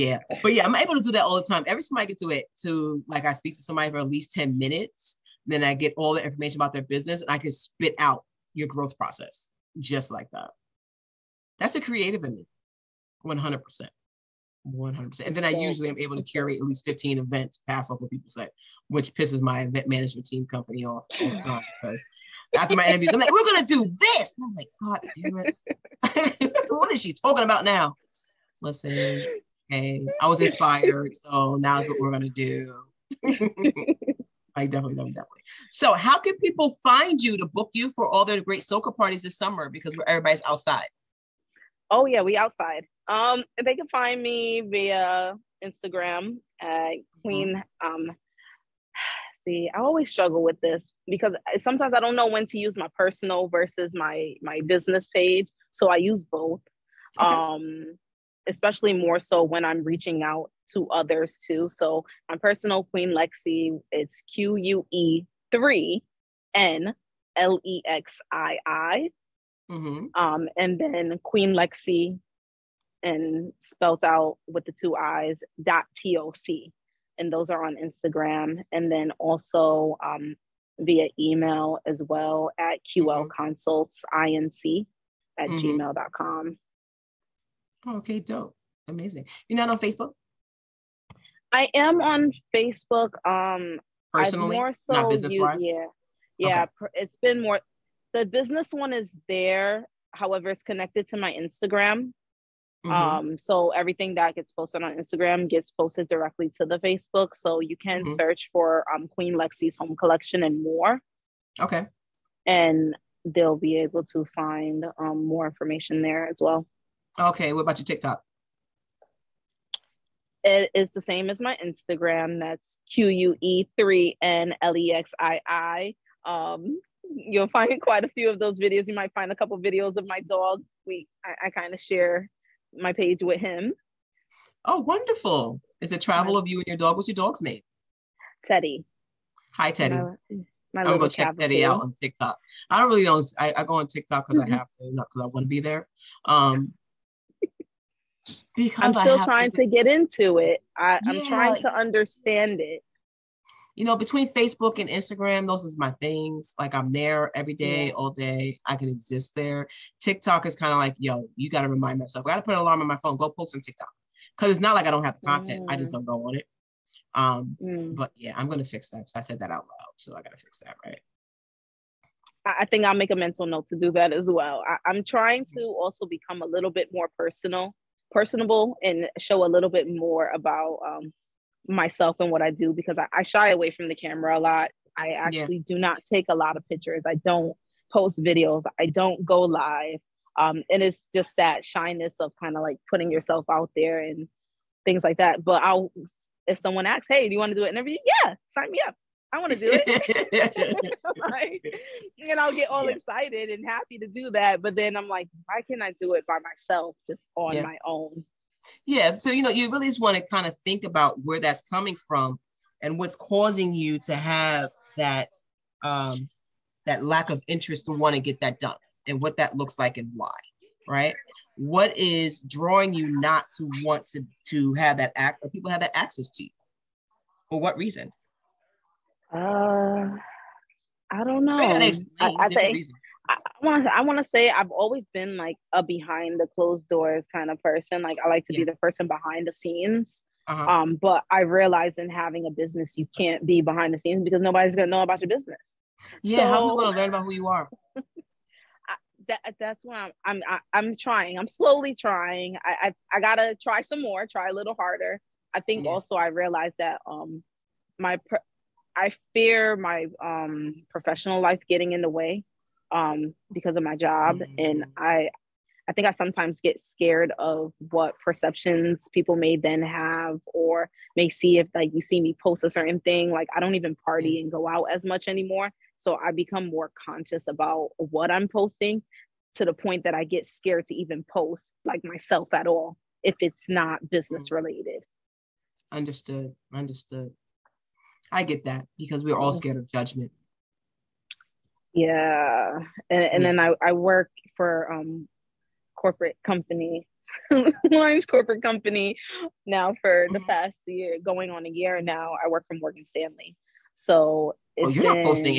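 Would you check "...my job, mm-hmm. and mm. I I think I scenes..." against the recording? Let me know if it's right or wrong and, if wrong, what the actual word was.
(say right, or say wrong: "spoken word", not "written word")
wrong: "sometimes", not "scenes".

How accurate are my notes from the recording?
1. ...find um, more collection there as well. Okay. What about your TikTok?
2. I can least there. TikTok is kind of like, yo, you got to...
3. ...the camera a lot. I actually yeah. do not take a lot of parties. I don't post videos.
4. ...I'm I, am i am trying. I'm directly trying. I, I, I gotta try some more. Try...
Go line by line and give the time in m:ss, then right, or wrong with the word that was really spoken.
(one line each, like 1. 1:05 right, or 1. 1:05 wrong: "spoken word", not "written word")
1. 1:54 wrong: "information", not "collection"
2. 2:38 wrong: "exist", not "least"
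3. 3:03 wrong: "pictures", not "parties"
4. 4:10 wrong: "slowly", not "directly".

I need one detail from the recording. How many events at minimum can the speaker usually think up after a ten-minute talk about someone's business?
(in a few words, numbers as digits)
15.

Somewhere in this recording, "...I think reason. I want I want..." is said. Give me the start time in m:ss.
3:52.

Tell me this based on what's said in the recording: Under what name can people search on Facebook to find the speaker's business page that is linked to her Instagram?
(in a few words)
Queen Lexii's Home Collection.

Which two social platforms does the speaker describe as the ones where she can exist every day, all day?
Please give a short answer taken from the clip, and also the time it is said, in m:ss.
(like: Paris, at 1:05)
Facebook and Instagram, at 2:34.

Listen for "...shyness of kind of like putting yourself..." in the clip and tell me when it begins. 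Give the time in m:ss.
3:11.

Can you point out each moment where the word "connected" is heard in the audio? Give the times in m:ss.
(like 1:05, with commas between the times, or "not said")
1:40.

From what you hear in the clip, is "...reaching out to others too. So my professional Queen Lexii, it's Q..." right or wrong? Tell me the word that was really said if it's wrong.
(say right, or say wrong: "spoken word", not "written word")
wrong: "personal", not "professional".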